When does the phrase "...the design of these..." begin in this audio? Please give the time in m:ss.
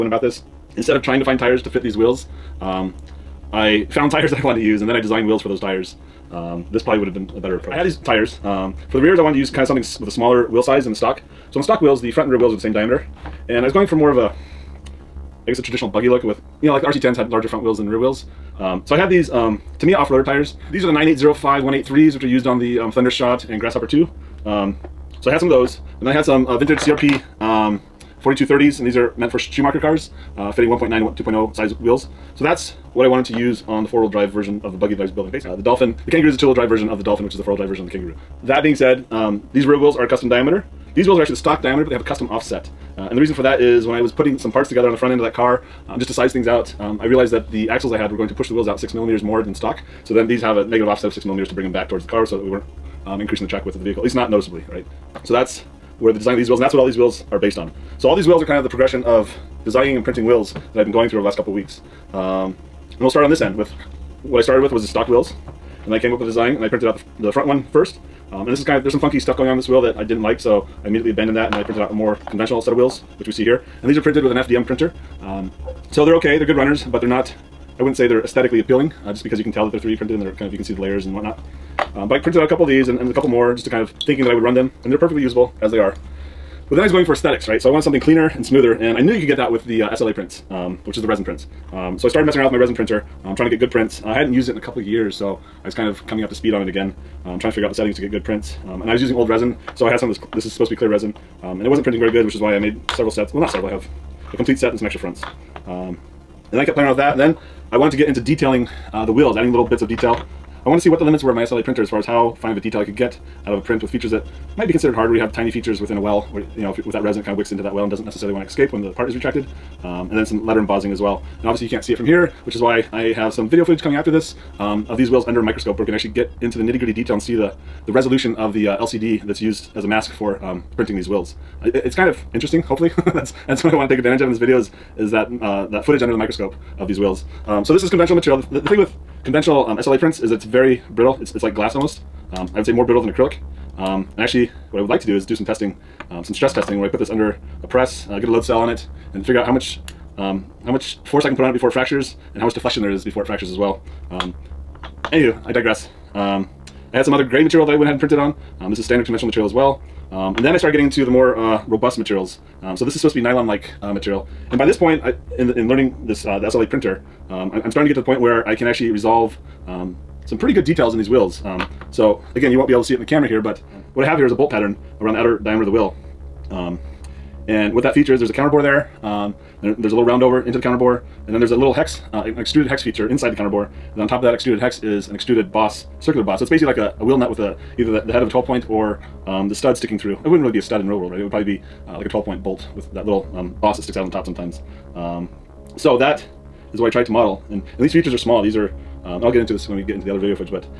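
0:56.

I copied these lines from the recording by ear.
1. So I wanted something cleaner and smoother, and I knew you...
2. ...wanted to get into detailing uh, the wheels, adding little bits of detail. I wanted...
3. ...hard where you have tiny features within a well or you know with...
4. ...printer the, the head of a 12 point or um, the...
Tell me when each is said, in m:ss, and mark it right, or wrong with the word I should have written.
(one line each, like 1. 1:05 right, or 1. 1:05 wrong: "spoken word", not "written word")
1. 1:27 right
2. 1:47 right
3. 1:54 right
4. 3:07 wrong: "either", not "printer".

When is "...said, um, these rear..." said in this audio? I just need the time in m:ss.
0:38.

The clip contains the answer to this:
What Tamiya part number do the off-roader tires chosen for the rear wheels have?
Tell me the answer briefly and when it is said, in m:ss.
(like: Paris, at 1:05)
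9805 183, at 0:20.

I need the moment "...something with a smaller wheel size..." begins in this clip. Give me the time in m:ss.
0:09.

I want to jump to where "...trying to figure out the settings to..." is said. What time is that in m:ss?
1:37.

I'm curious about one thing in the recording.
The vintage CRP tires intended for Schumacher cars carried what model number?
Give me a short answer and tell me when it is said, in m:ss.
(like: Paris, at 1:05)
4230, at 0:28.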